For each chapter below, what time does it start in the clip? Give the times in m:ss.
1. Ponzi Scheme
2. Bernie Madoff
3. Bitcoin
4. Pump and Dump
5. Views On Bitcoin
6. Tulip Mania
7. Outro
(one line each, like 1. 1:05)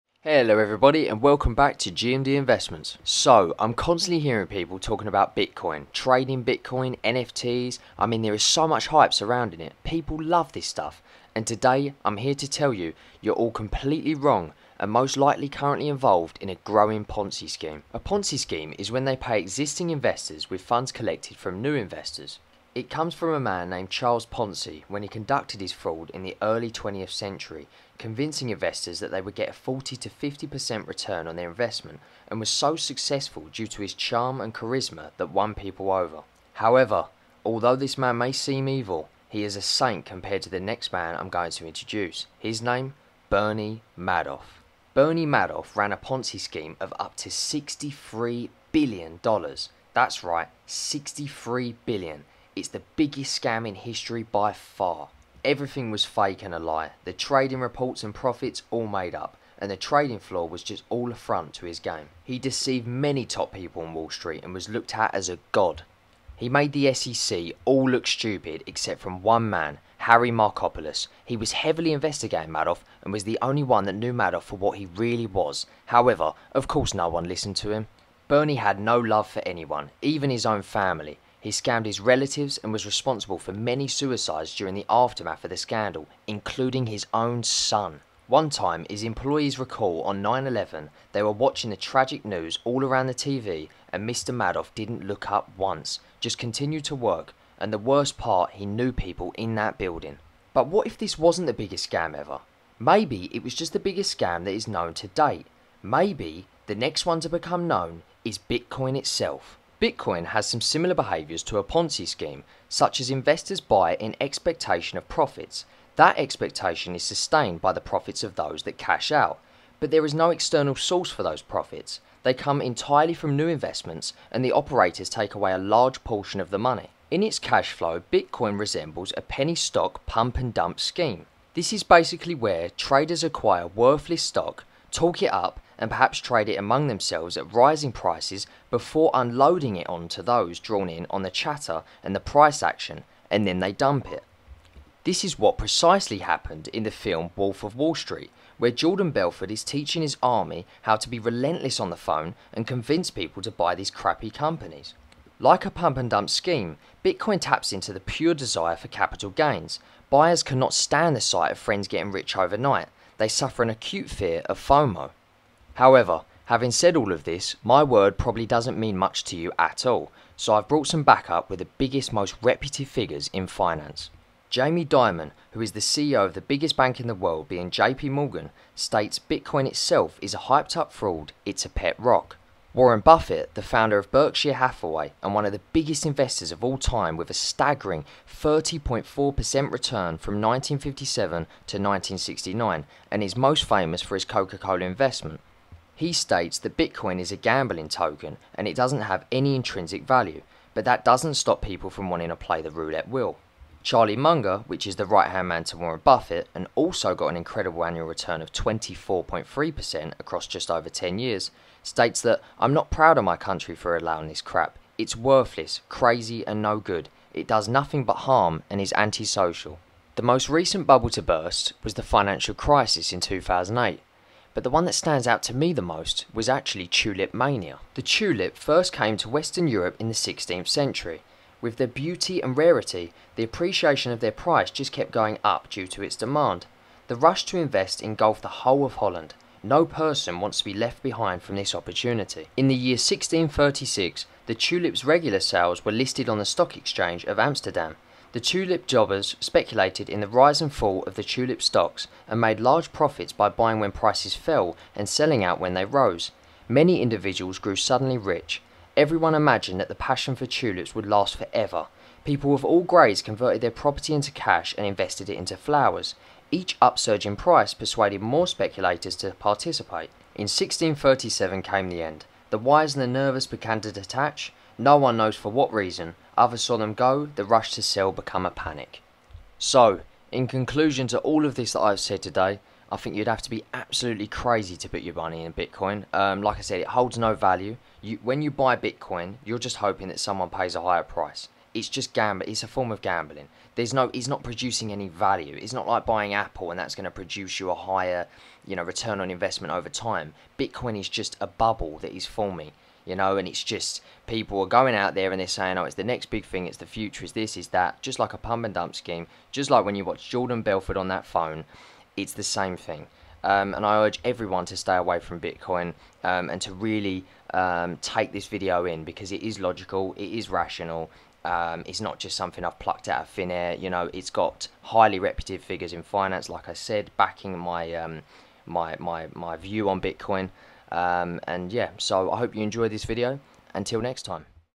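1. 0:18
2. 0:43
3. 1:50
4. 2:07
5. 2:45
6. 3:40
7. 4:40.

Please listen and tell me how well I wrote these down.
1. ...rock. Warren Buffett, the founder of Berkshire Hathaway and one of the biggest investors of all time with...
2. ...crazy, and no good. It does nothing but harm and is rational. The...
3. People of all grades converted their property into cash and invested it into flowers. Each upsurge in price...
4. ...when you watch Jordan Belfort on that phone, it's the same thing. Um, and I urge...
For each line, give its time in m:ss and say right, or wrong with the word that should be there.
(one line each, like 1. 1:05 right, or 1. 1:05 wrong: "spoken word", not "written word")
1. 3:01 right
2. 3:35 wrong: "antisocial", not "rational"
3. 4:22 right
4. 5:09 right.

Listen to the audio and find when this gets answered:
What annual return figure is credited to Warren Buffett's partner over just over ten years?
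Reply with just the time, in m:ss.
3:28.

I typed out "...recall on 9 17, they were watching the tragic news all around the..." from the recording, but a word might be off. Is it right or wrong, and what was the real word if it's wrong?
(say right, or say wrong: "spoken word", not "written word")
wrong: "11", not "17".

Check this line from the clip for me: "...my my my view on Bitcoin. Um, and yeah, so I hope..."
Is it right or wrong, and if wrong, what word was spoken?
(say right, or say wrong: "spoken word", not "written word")
right.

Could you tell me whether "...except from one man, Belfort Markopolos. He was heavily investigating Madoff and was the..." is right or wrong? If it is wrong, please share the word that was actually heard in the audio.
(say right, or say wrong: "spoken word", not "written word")
wrong: "Harry", not "Belfort".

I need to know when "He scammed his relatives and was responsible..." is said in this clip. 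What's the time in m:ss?
1:21.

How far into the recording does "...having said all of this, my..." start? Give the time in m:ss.
2:46.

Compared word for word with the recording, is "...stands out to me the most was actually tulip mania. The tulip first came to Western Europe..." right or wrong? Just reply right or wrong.
right.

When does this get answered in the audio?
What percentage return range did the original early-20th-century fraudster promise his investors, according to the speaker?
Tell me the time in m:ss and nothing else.
0:29.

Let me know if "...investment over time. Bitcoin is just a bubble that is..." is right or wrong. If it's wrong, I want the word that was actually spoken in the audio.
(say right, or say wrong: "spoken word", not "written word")
right.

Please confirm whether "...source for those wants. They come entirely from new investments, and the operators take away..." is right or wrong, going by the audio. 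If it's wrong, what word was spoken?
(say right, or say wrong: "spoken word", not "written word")
wrong: "profits", not "wants".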